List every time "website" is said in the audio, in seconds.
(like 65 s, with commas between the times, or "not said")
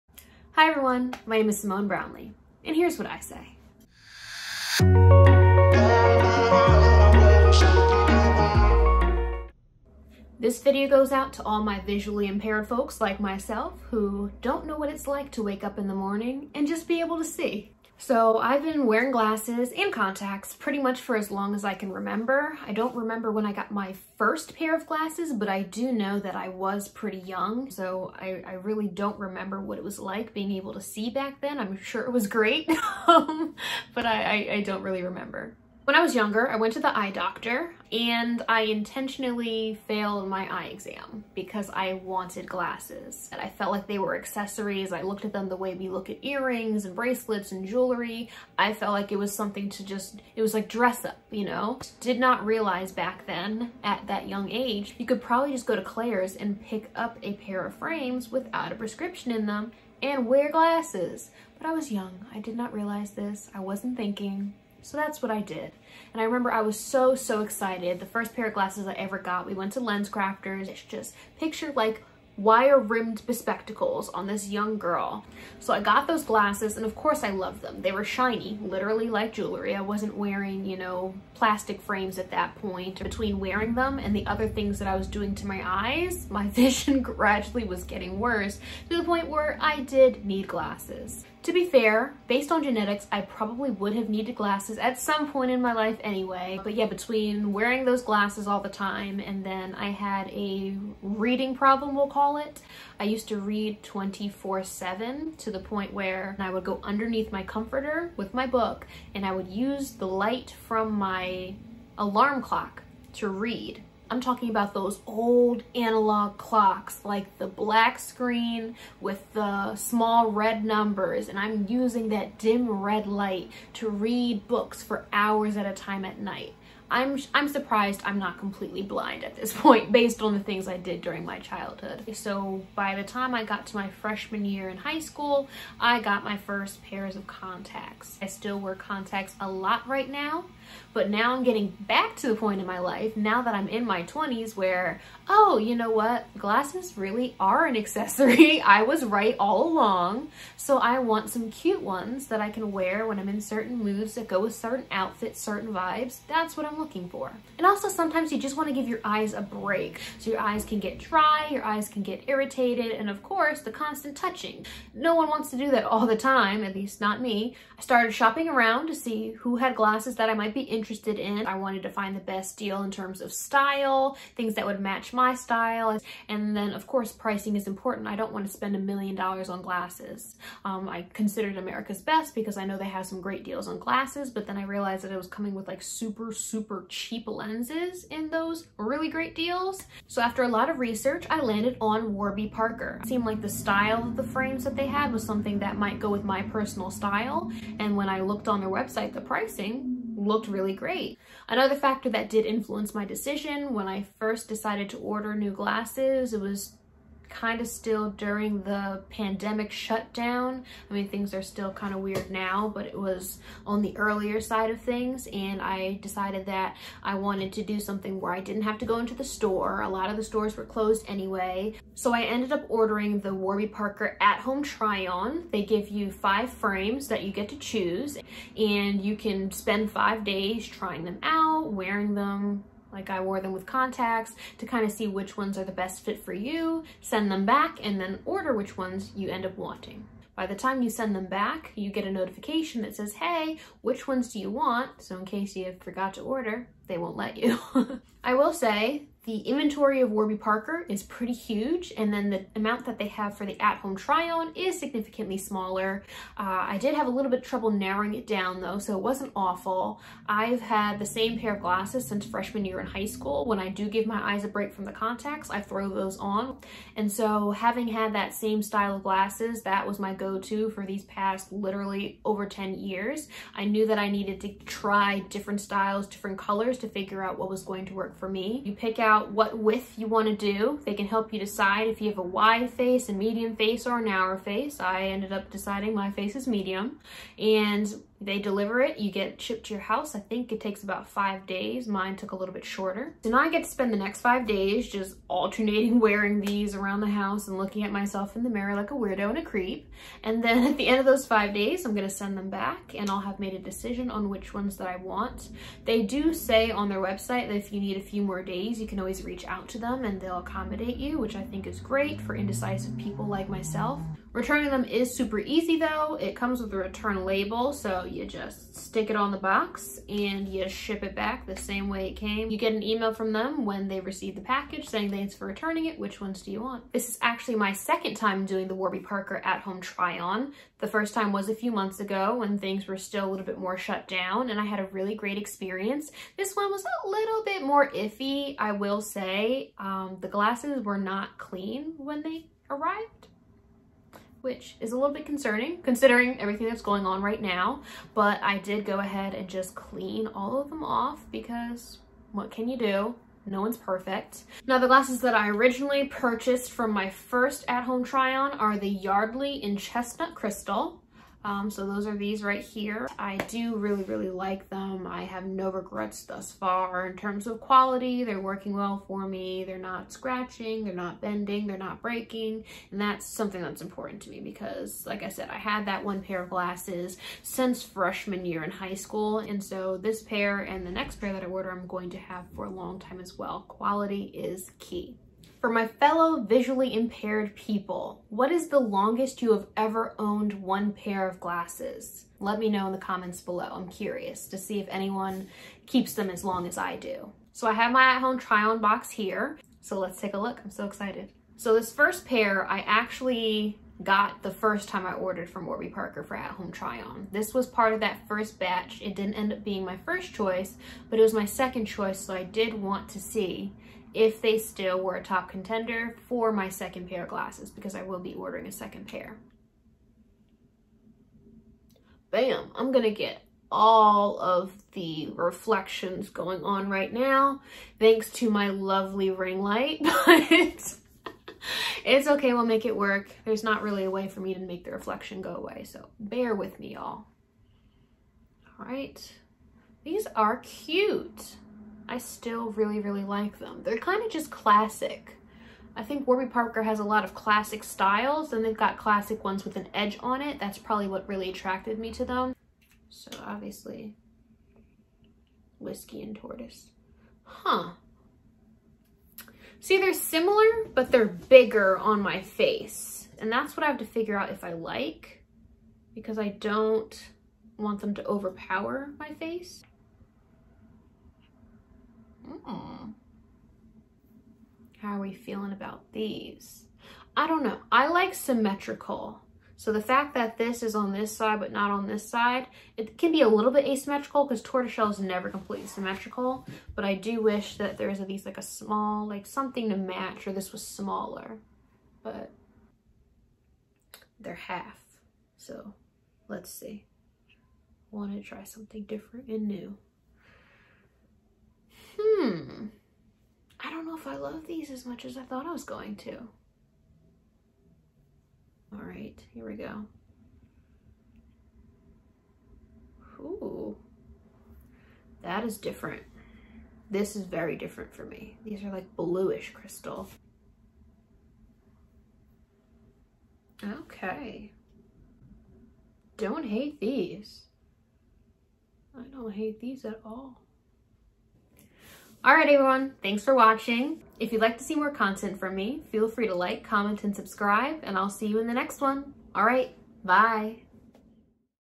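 198 s, 307 s.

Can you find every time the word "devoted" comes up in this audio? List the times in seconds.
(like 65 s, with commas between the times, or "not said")
not said.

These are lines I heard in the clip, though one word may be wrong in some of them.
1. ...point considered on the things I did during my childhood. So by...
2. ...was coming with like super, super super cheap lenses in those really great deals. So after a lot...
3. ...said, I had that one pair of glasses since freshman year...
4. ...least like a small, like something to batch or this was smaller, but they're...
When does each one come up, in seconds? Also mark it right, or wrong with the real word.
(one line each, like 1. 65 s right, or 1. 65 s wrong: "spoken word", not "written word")
1. 129 s wrong: "based", not "considered"
2. 185 s right
3. 375 s right
4. 488 s wrong: "match", not "batch".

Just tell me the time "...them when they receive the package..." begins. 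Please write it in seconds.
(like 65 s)
323 s.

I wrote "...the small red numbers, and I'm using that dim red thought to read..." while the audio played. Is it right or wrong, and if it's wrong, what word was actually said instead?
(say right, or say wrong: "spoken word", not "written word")
wrong: "light", not "thought".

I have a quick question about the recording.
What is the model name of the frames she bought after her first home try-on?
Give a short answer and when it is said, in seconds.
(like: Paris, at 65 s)
Yardley, at 358 s.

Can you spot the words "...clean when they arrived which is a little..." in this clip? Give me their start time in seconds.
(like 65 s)
341 s.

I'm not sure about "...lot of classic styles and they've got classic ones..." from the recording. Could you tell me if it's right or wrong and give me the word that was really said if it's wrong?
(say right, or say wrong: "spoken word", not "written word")
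right.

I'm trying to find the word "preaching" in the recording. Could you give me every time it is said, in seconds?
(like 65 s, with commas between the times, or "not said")
not said.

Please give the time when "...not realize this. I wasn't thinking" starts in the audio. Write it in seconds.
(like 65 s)
62 s.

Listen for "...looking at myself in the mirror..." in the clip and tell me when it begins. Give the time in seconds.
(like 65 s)
297 s.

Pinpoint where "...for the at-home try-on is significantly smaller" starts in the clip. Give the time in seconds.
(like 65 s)
253 s.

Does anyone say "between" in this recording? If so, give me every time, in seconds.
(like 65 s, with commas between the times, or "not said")
83 s, 96 s.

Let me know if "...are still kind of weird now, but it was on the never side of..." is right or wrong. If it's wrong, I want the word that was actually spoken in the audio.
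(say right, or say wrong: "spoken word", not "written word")
wrong: "earlier", not "never".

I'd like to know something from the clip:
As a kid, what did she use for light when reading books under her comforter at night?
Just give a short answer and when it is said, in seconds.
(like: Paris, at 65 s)
alarm clock, at 111 s.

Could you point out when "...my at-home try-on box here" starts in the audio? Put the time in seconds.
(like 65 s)
397 s.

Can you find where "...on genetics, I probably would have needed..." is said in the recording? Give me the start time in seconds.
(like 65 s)
92 s.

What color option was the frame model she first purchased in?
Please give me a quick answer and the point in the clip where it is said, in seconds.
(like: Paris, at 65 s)
Chestnut Crystal, at 359 s.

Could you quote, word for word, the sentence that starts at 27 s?
So I, I really don't remember what it was like being able to see back then.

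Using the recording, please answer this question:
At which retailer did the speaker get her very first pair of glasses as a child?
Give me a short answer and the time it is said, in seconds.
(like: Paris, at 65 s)
LensCrafters, at 69 s.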